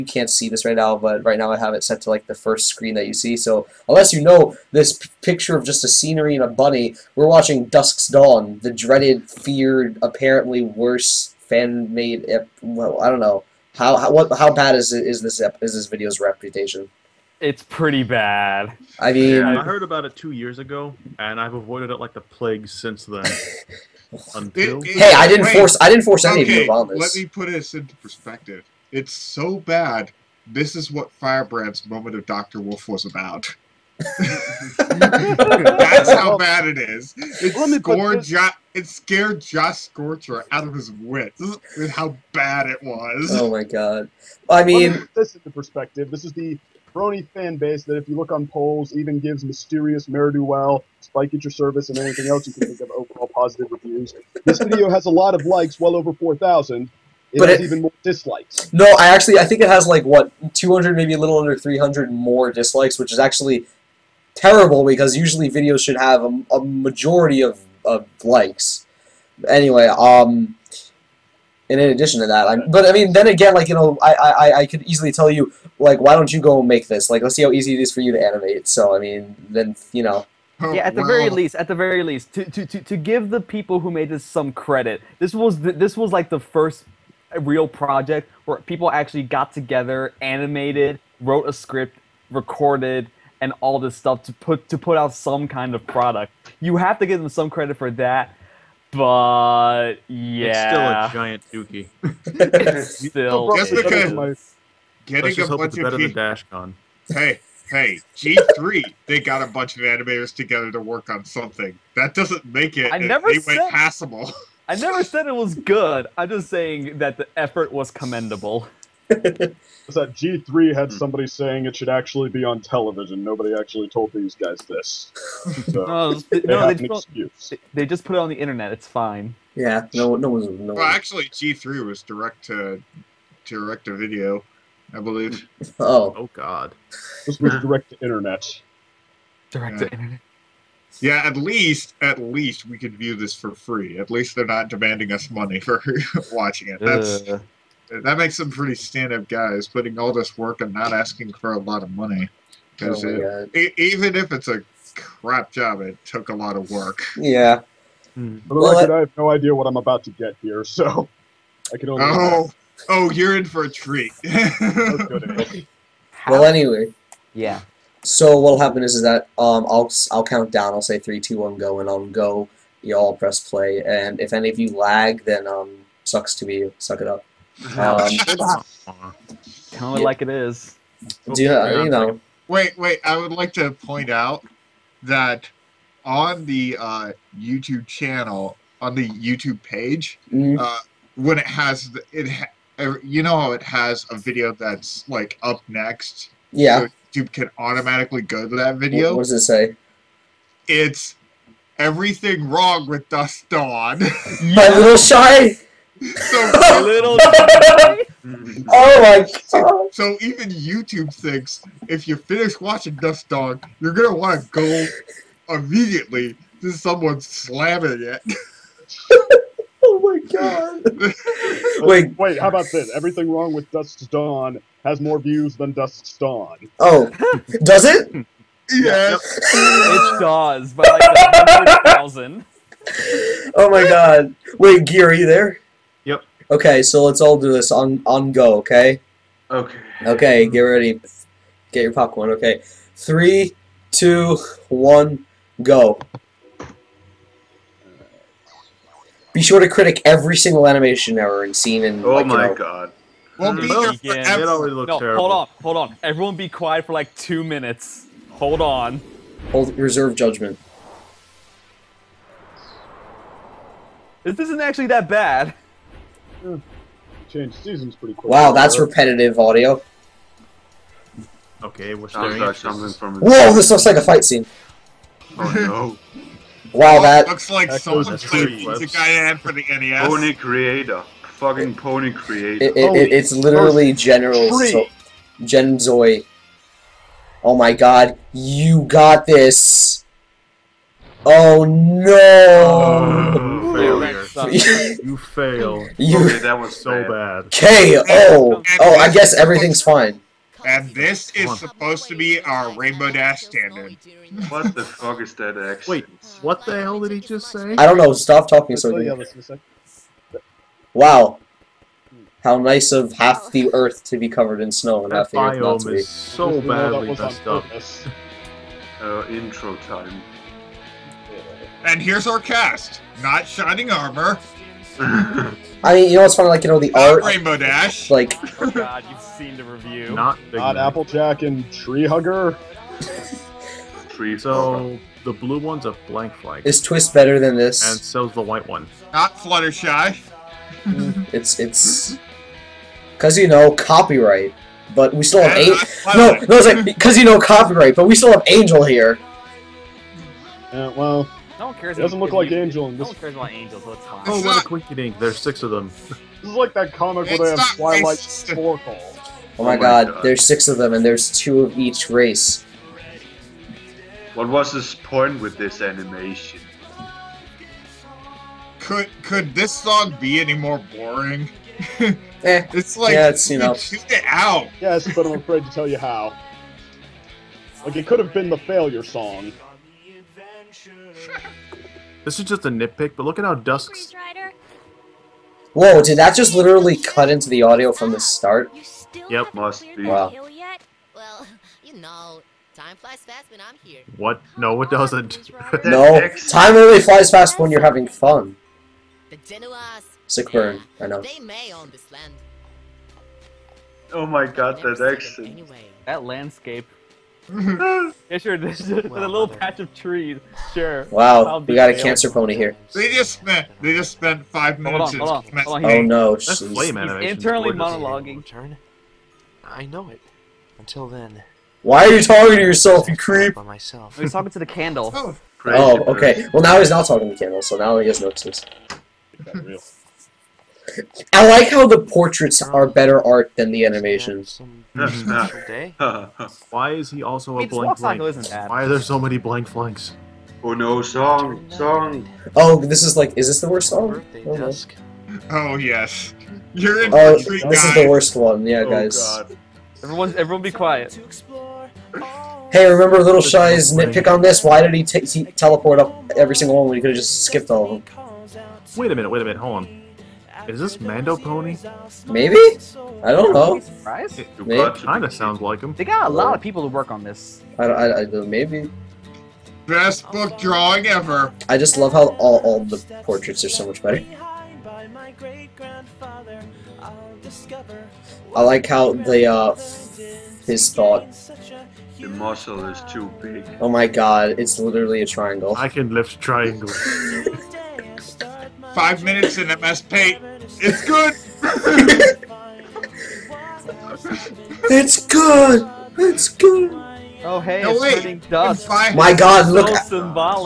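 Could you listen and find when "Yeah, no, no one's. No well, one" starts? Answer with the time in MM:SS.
02:09.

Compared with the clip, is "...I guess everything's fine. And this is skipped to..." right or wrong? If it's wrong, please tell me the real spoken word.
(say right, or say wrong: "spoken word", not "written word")
wrong: "supposed", not "skipped".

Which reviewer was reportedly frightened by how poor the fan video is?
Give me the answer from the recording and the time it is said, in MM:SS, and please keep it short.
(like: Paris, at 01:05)
Josh Scorcher, at 00:39.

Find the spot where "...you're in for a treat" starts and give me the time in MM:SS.
02:43.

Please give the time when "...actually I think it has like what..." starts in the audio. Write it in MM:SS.
00:59.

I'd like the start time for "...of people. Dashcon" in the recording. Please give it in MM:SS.
01:45.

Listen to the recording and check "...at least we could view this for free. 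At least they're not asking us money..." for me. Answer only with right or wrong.
wrong.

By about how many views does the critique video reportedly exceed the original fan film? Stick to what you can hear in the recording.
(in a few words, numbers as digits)
100,000.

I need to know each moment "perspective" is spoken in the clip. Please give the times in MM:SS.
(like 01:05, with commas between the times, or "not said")
00:27, 00:45.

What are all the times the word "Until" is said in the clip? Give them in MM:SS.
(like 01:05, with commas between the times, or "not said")
07:00.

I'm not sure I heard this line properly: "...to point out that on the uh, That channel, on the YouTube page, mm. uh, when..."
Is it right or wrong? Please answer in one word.
wrong.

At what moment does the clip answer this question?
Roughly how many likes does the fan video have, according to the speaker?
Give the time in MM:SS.
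00:55.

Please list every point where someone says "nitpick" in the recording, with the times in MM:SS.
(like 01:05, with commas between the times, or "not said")
06:22, 07:33.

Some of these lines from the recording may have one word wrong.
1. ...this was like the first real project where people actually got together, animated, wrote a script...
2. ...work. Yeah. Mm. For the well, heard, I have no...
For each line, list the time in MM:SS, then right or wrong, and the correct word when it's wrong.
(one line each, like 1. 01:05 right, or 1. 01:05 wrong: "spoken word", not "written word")
1. 01:25 right
2. 02:36 wrong: "record", not "heard".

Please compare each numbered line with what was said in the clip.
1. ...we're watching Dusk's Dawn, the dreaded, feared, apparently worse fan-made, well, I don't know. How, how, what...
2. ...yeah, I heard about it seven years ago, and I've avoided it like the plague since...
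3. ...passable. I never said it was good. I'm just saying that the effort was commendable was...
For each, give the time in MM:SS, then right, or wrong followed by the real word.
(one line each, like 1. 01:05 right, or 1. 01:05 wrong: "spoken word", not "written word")
1. 00:07 right
2. 00:19 wrong: "two", not "seven"
3. 01:53 right.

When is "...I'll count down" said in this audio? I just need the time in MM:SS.
02:50.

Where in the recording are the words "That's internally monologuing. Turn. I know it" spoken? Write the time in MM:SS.
06:56.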